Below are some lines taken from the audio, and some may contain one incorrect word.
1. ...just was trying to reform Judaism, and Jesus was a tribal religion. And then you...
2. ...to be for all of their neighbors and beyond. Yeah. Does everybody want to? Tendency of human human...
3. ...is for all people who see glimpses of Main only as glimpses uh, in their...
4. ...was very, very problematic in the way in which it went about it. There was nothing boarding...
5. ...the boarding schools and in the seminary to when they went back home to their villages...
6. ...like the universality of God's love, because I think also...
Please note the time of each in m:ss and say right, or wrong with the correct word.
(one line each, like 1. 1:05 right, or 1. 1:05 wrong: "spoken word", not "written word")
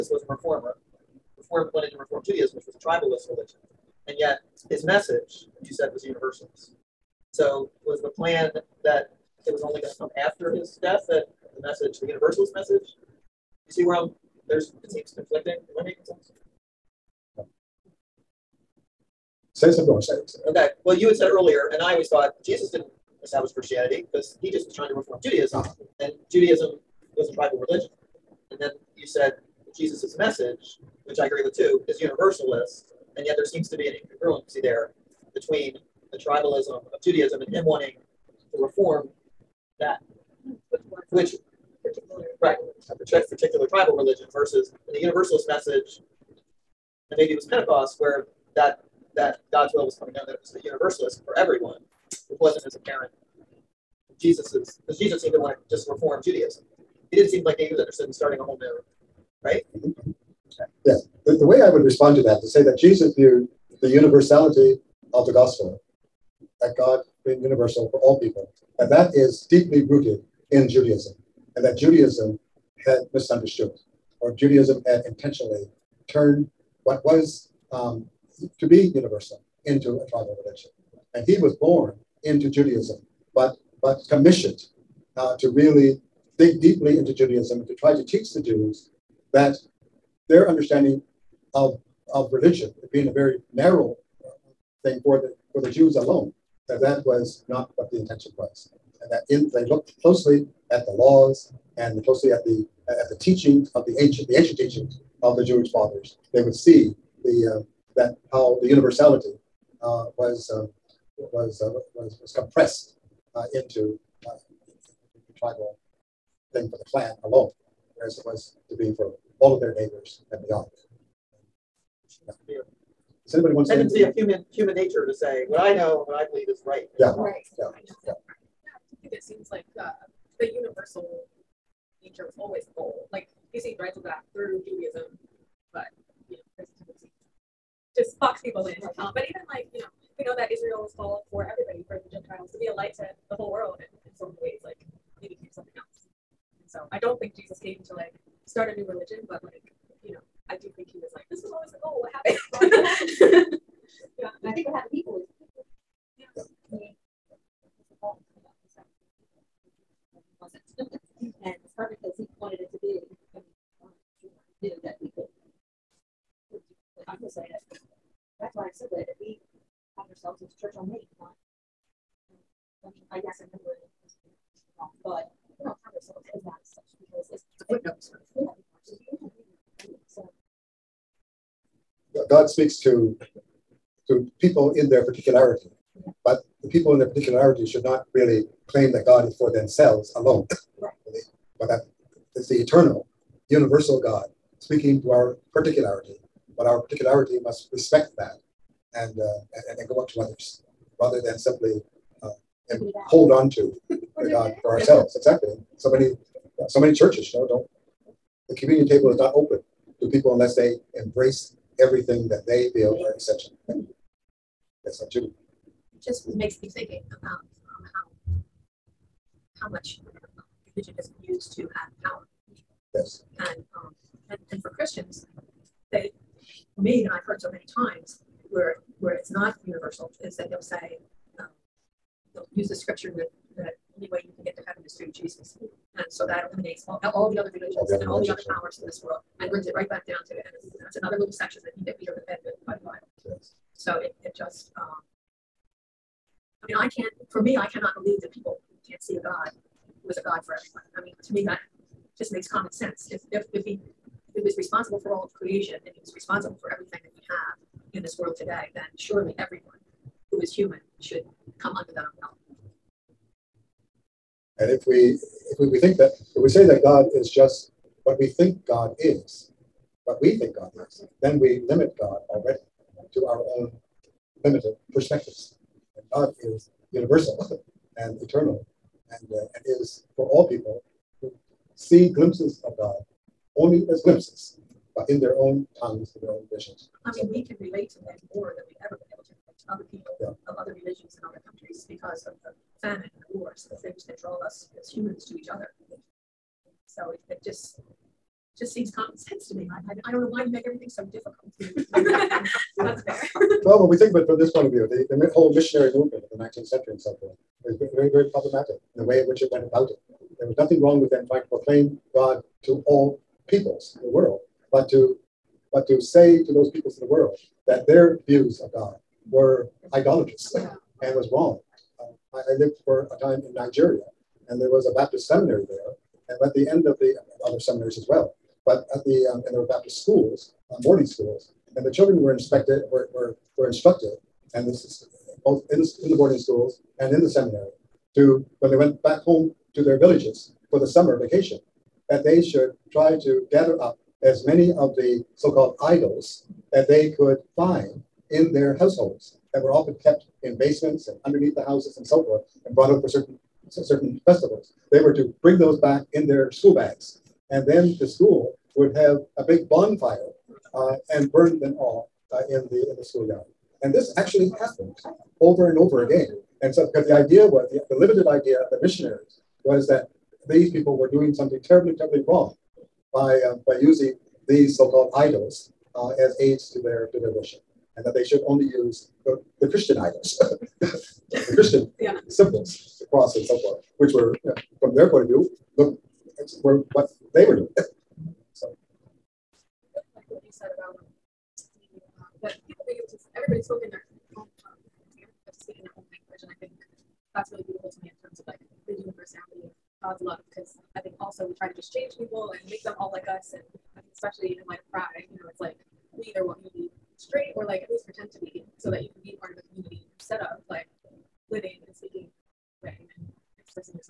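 1. 0:24 wrong: "Judaism", not "Jesus"
2. 1:58 wrong: "anybody", not "everybody"
3. 4:39 wrong: "God", not "Main"
4. 5:07 wrong: "wrong", not "boarding"
5. 5:36 right
6. 6:38 right.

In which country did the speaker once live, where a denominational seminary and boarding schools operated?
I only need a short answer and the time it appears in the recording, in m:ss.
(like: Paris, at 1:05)
Nigeria, at 5:23.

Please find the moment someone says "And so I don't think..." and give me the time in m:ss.
2:26.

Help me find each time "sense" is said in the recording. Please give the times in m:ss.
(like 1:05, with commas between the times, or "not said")
0:16, 4:12, 4:59.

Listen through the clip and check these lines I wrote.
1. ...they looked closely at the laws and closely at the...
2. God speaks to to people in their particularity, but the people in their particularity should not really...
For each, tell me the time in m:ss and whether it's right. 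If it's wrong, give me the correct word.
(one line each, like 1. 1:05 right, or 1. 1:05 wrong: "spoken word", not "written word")
1. 1:39 right
2. 3:02 right.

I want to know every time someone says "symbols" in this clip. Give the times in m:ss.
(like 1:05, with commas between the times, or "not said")
6:22.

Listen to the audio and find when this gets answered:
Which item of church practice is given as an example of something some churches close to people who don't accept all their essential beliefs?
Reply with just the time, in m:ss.
3:28.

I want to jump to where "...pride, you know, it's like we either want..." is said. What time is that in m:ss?
6:44.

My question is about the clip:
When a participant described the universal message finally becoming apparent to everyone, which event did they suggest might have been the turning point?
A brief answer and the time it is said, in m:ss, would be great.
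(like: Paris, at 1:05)
Pentecost, at 0:47.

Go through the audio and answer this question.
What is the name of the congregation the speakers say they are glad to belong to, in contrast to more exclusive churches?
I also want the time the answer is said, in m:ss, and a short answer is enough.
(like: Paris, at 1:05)
Church on Main, at 2:50.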